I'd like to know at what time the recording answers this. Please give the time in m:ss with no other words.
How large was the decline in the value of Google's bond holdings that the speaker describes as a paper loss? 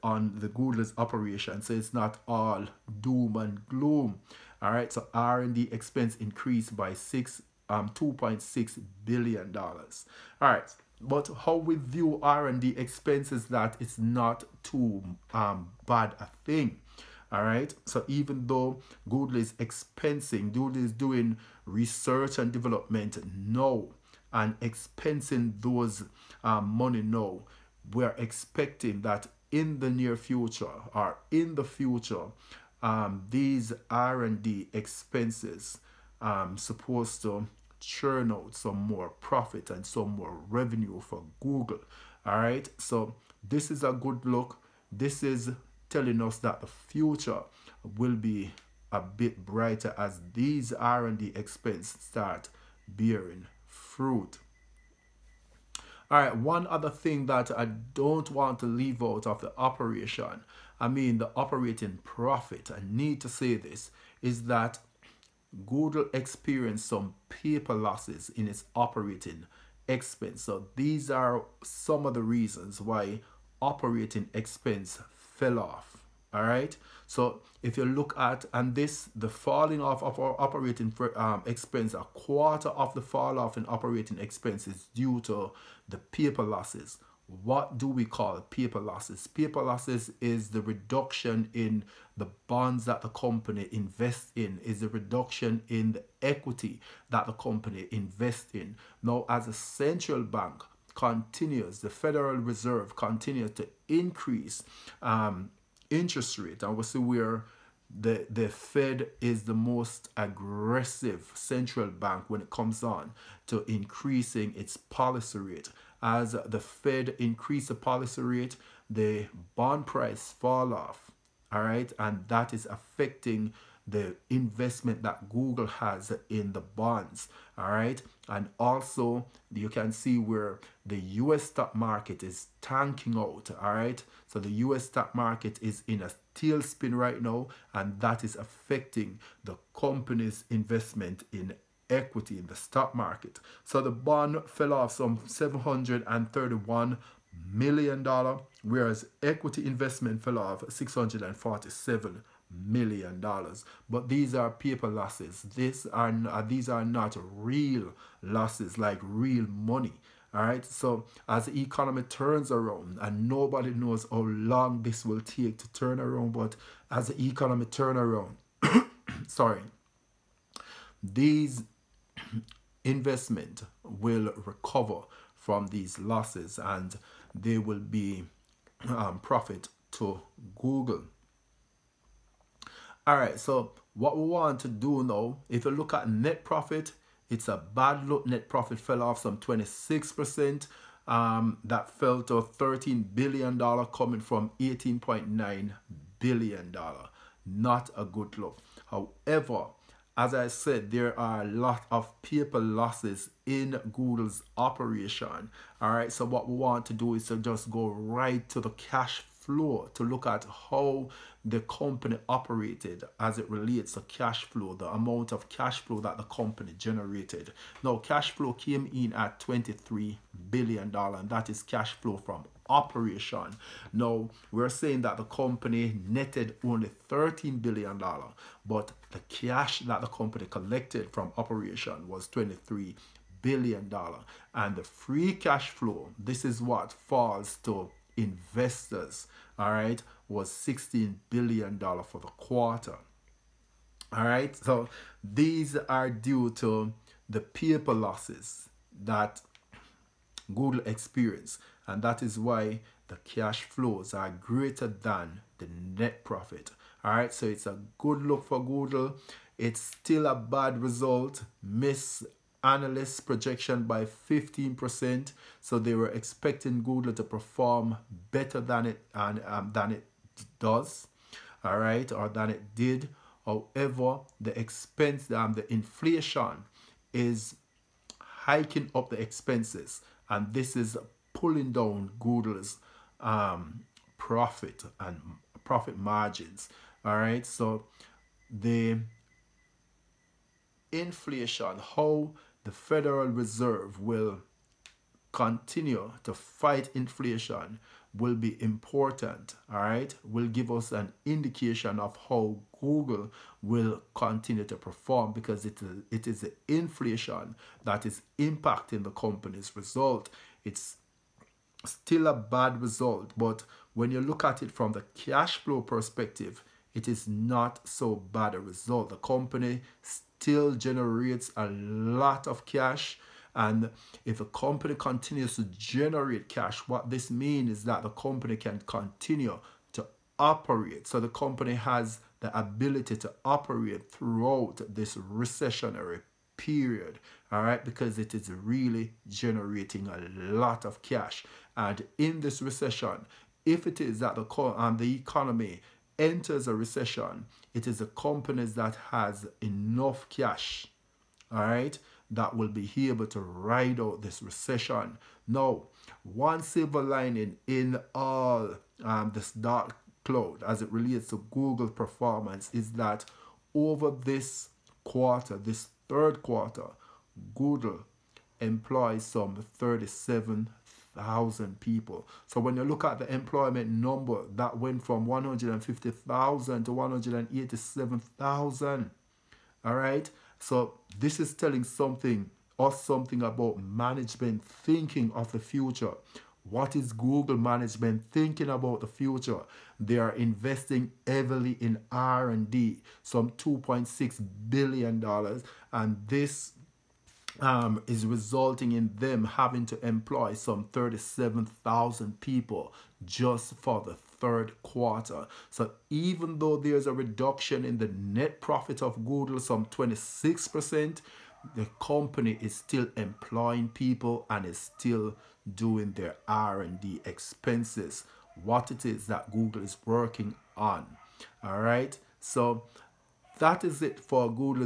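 2:25.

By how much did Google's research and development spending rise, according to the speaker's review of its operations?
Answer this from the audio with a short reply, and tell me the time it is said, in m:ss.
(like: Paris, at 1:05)
$2.6 billion, at 0:07.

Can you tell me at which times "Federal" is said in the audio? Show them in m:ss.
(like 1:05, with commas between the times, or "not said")
1:41, 4:52.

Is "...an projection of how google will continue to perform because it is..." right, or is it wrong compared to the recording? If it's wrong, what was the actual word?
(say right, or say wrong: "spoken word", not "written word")
wrong: "indication", not "projection".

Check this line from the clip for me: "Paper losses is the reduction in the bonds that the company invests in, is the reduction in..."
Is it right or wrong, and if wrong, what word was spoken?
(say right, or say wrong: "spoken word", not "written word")
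right.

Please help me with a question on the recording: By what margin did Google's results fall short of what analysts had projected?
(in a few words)
15%.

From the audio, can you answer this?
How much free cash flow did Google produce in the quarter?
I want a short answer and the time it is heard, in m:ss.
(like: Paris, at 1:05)
$16 billion, at 4:00.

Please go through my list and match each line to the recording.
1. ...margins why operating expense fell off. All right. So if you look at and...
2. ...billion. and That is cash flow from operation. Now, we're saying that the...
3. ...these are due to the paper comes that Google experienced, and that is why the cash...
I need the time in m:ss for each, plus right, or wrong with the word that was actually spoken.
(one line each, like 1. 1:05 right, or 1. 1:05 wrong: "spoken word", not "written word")
1. 1:12 wrong: "reasons", not "margins"
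2. 3:40 right
3. 4:05 wrong: "losses", not "comes".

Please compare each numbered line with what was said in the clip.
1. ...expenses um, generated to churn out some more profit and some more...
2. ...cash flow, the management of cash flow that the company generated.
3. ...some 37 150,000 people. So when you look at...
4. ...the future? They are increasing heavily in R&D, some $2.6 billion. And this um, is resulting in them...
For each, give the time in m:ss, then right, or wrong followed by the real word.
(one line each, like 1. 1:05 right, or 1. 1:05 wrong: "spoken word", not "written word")
1. 0:34 wrong: "supposed", not "generated"
2. 3:34 wrong: "amount", not "management"
3. 6:09 right
4. 6:29 wrong: "investing", not "increasing".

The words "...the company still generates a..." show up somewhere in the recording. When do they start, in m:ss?
5:19.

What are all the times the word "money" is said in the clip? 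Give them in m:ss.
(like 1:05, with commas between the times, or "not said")
0:26, 2:39.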